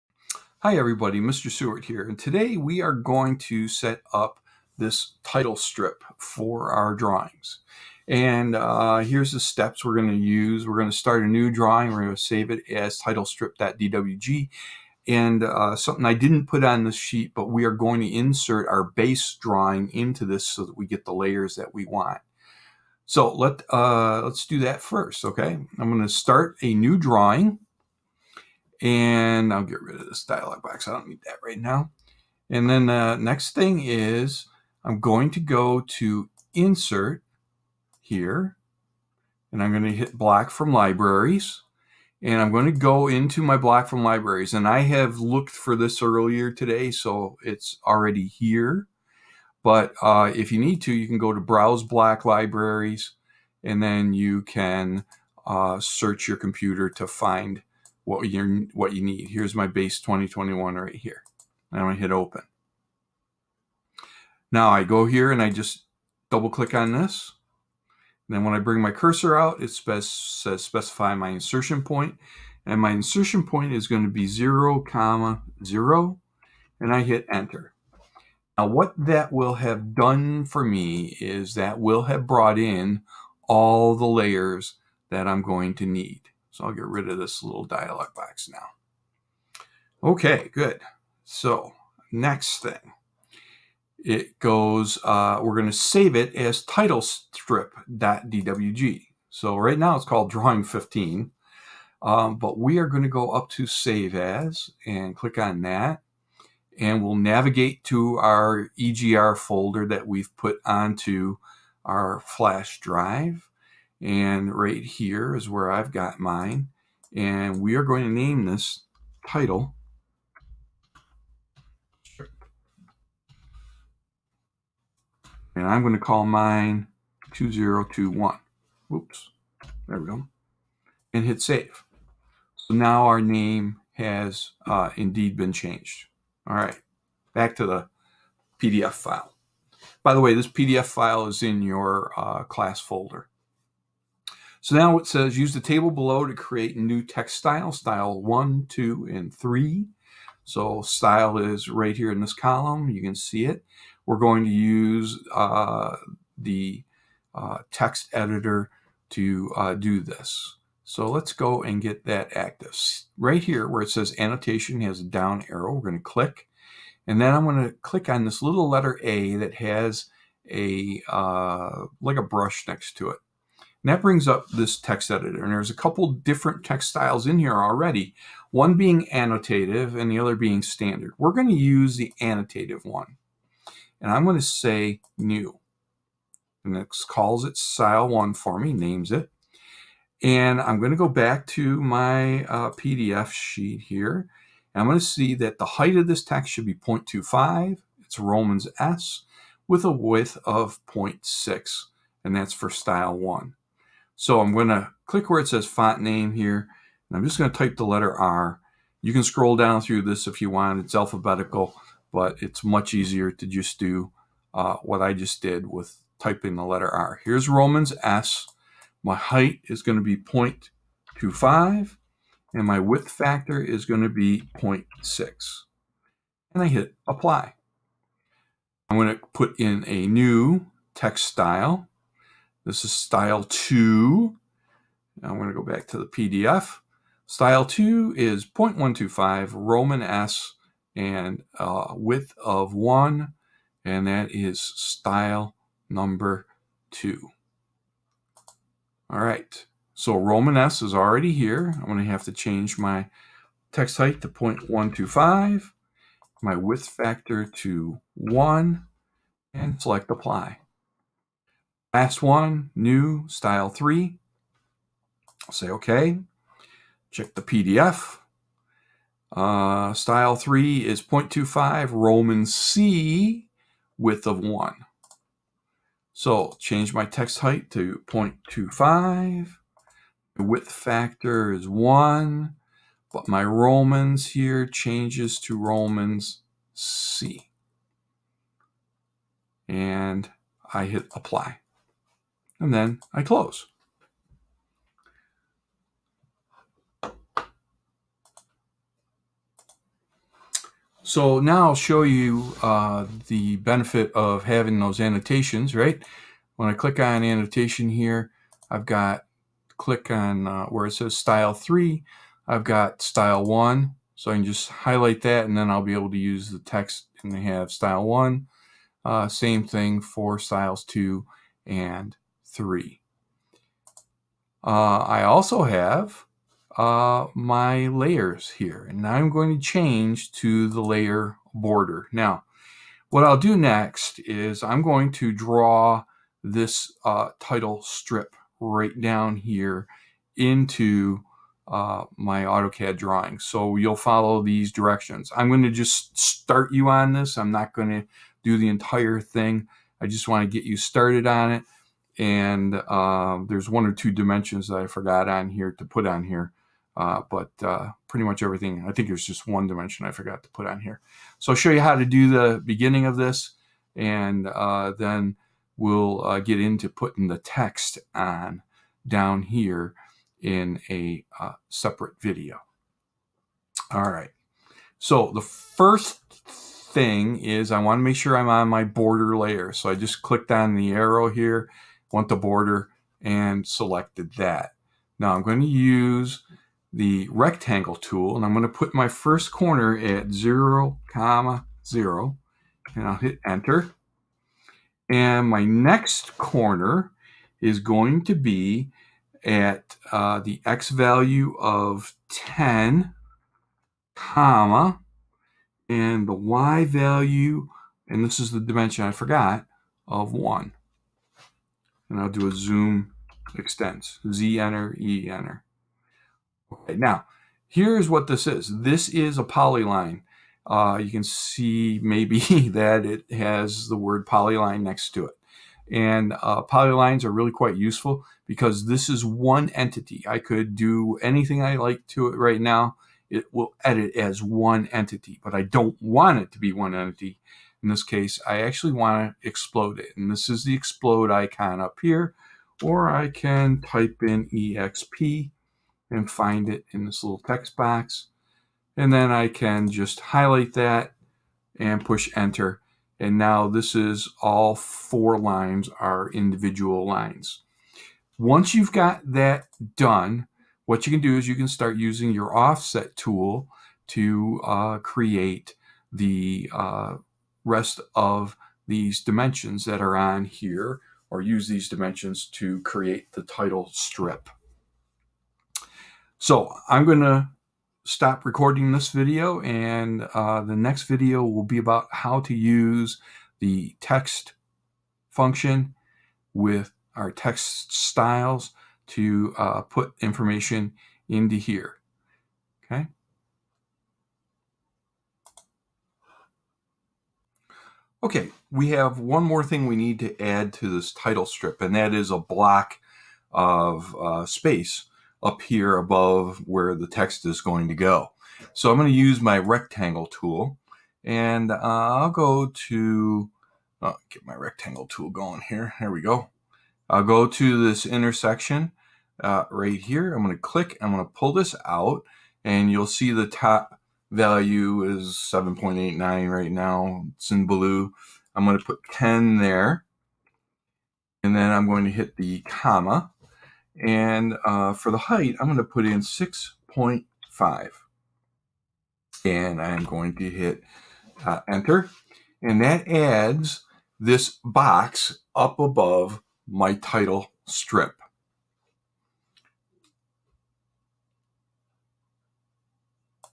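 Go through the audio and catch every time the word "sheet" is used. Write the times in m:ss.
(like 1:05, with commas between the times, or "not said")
0:16, 3:13.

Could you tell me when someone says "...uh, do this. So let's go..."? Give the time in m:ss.
2:39.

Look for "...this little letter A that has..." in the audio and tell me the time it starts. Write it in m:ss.
2:48.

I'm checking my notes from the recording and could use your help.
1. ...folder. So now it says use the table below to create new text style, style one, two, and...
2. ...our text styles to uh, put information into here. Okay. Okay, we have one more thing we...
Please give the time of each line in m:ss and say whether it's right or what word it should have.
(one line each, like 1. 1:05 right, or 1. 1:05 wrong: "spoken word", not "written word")
1. 2:22 right
2. 8:07 right.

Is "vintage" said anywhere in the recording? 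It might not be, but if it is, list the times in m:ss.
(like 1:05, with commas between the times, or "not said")
not said.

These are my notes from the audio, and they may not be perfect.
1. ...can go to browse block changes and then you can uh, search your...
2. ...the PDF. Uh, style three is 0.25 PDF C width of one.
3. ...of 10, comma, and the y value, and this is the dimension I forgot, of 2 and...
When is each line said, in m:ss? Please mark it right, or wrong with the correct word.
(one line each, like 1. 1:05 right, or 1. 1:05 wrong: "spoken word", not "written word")
1. 0:51 wrong: "libraries", not "changes"
2. 4:27 wrong: "Roman", not "PDF"
3. 6:41 wrong: "1", not "2".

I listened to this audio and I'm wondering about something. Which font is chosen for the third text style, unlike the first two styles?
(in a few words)
Romans C.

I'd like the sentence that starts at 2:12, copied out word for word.
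So now our name has uh, indeed been changed.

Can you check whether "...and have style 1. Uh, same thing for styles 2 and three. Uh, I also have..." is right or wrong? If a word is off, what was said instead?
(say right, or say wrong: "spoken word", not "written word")
right.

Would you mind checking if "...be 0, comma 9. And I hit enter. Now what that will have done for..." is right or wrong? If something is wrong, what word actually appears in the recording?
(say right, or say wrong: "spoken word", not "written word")
wrong: "0", not "9".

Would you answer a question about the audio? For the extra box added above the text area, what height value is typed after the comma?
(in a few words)
6.5.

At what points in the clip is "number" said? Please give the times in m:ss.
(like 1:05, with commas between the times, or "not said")
4:05.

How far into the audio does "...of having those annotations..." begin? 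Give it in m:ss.
5:04.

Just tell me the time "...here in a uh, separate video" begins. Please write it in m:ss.
6:09.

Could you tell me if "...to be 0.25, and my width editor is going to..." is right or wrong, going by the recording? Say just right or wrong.
wrong.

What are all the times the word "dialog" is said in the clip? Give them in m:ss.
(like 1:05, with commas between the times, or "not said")
0:30, 1:27.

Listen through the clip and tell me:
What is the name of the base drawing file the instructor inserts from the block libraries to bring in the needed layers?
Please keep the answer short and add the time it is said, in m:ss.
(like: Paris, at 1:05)
base 2021, at 0:59.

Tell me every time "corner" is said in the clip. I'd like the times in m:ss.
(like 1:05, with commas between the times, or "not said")
6:29, 6:36.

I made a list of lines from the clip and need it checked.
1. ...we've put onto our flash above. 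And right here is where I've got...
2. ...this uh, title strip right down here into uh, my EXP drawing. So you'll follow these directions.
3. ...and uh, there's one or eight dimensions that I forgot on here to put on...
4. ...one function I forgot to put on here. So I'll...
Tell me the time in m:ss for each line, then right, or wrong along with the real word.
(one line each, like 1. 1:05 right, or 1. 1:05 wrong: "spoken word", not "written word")
1. 1:50 wrong: "drive", not "above"
2. 5:36 wrong: "AutoCAD", not "EXP"
3. 5:52 wrong: "two", not "eight"
4. 5:59 wrong: "dimension", not "function".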